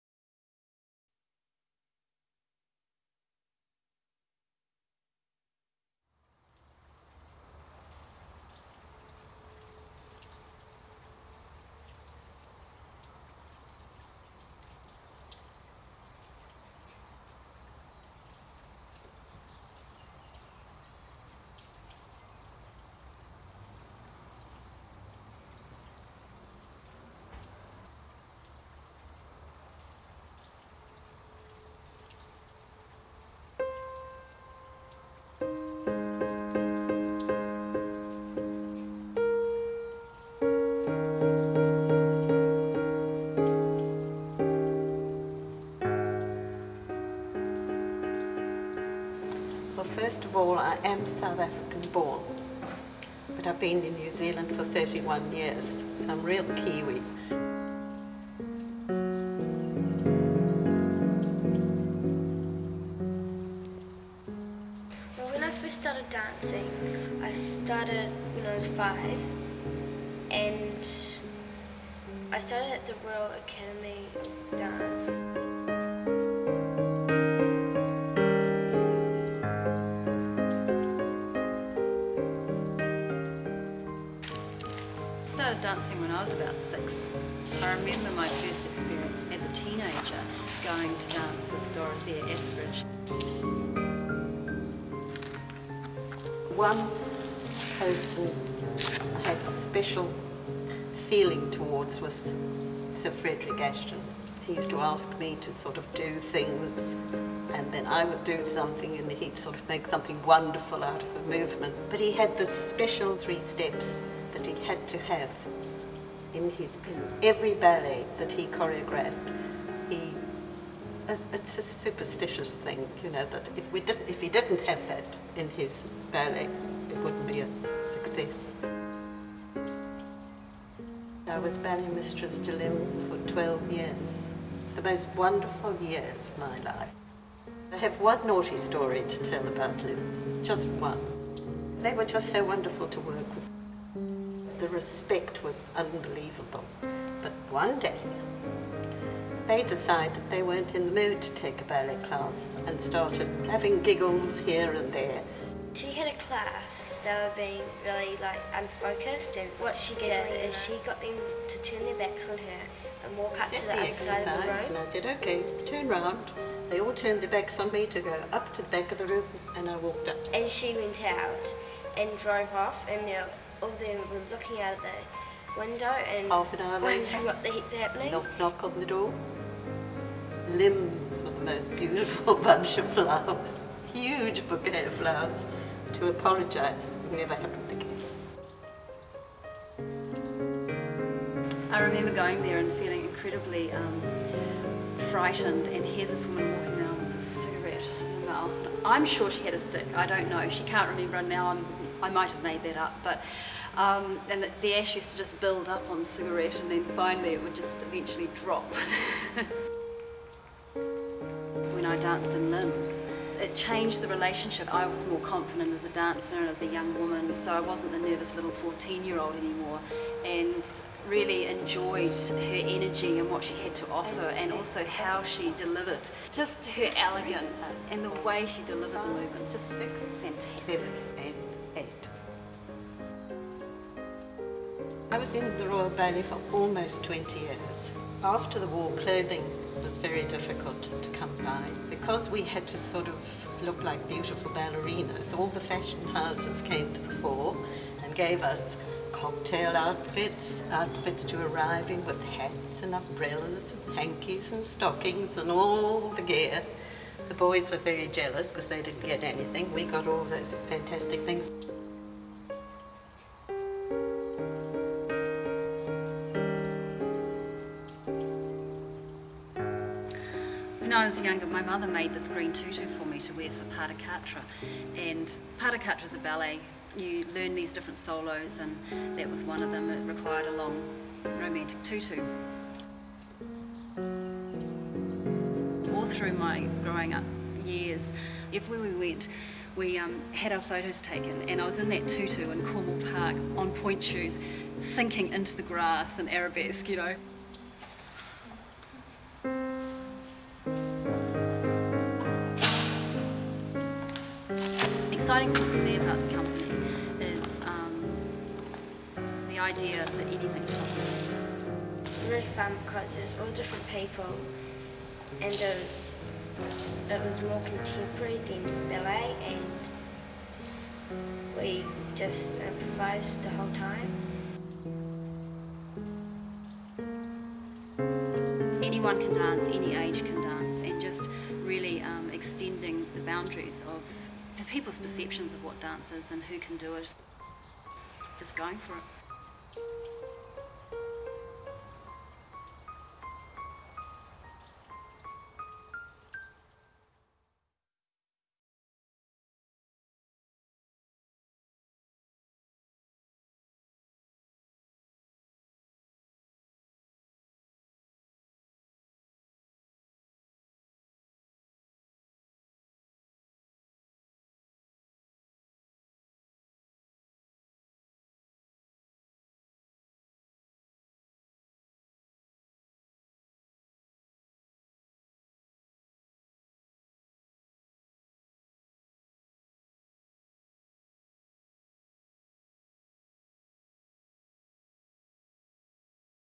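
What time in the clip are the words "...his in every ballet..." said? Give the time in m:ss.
1:56.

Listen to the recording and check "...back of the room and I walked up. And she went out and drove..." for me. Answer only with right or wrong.
right.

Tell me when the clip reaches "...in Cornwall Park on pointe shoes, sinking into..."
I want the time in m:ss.
4:52.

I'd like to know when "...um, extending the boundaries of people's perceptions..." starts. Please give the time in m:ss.
5:32.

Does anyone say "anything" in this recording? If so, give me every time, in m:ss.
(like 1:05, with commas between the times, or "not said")
4:19, 5:10.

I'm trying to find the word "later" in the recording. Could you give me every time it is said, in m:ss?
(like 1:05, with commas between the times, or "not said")
2:56.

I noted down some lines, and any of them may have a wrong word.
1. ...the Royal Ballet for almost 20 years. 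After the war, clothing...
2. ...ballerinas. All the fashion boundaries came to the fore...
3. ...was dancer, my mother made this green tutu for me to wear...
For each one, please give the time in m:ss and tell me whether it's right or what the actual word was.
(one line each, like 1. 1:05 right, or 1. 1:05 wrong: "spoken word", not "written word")
1. 3:55 right
2. 4:04 wrong: "houses", not "boundaries"
3. 4:31 wrong: "younger", not "dancer".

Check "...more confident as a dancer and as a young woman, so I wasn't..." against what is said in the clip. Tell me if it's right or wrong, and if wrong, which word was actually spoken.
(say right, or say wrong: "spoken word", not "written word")
right.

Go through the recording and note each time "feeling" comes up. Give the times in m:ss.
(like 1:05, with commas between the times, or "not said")
1:40, 3:12.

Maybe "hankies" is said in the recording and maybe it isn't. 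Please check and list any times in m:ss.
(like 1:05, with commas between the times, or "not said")
4:13.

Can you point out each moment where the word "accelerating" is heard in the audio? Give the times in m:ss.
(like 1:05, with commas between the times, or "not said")
not said.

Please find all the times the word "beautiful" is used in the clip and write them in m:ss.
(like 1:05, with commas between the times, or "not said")
3:01, 4:04.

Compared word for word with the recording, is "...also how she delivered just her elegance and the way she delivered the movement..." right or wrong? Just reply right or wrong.
right.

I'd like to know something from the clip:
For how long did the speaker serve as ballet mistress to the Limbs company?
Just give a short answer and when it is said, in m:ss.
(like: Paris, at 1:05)
12 years, at 2:13.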